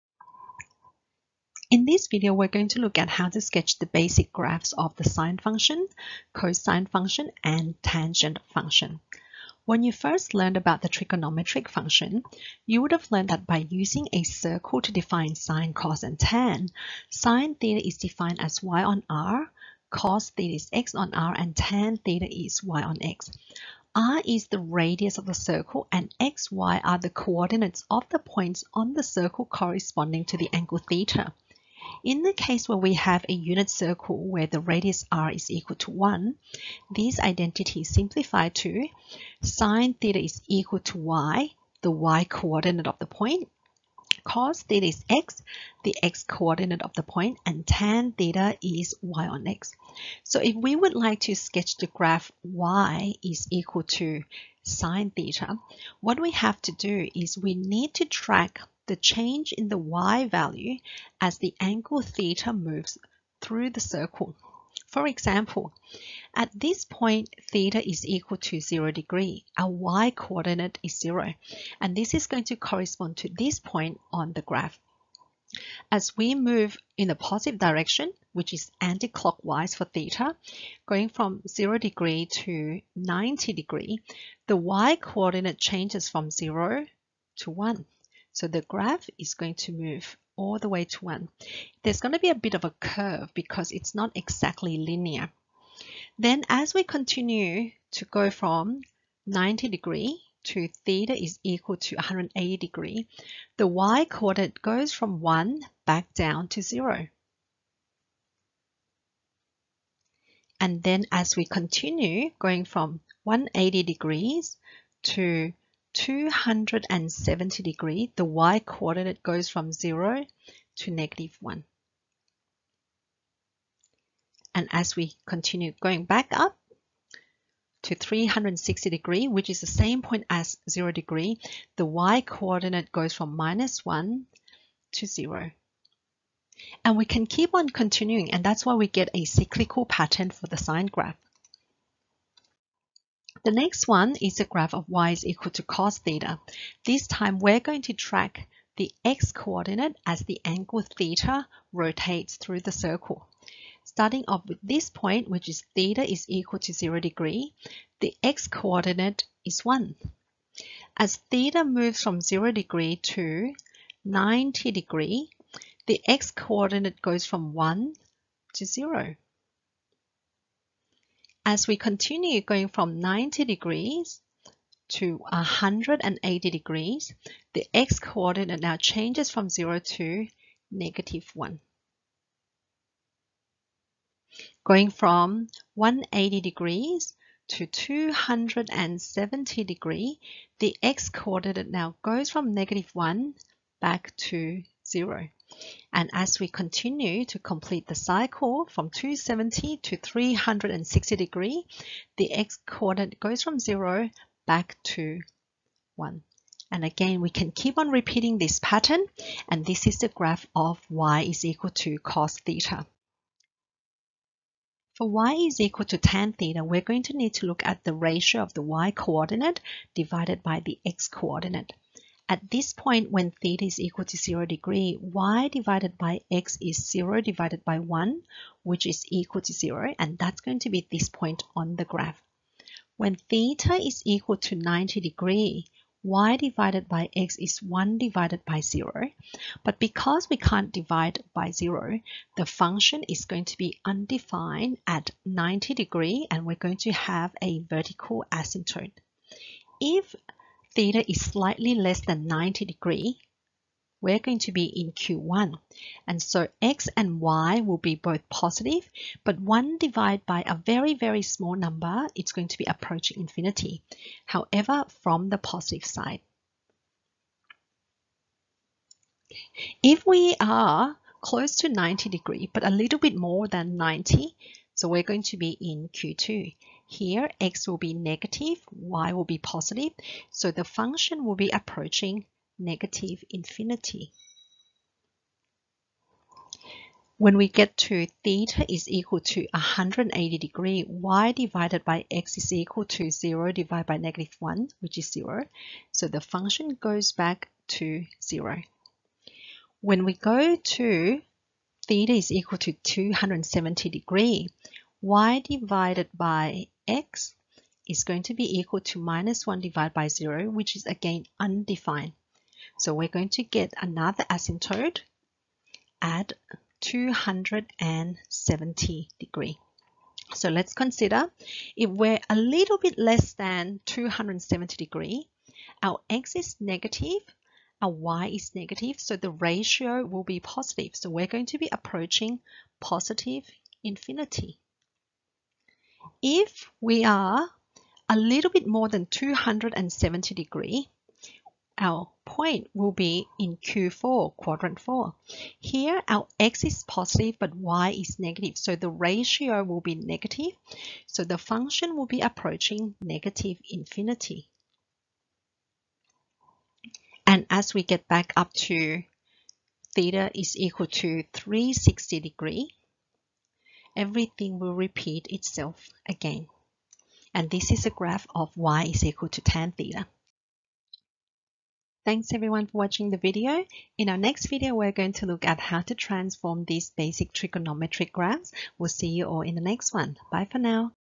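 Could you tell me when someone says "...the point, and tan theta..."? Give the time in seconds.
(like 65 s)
46 s.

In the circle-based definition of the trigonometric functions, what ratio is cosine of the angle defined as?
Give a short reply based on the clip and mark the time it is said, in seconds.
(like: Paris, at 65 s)
x on r, at 19 s.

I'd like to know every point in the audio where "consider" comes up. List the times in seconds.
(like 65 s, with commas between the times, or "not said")
320 s.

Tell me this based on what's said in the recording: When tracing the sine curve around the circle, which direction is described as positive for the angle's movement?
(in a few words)
anti-clockwise.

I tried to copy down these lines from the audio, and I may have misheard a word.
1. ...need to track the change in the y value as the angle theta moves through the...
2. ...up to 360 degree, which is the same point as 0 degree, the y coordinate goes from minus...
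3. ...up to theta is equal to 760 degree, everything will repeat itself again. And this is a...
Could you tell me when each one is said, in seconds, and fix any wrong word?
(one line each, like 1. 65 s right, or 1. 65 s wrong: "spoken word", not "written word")
1. 57 s right
2. 126 s right
3. 358 s wrong: "360", not "760".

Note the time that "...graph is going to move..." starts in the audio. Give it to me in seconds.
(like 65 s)
88 s.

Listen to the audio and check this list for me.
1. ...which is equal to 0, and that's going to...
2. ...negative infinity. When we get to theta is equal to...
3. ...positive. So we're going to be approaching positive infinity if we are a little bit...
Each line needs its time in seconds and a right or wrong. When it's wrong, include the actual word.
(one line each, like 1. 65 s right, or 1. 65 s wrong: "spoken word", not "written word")
1. 228 s right
2. 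282 s right
3. 330 s right.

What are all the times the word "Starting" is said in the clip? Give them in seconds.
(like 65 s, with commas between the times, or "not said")
153 s.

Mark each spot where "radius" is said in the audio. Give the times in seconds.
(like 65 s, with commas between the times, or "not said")
24 s, 34 s.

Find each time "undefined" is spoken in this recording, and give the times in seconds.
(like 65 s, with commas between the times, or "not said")
243 s, 311 s.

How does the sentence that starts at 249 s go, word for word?
If theta is slightly less than 90 degree, we're going to be in Q1.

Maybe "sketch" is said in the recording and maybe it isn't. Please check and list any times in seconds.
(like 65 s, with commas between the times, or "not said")
3 s, 51 s.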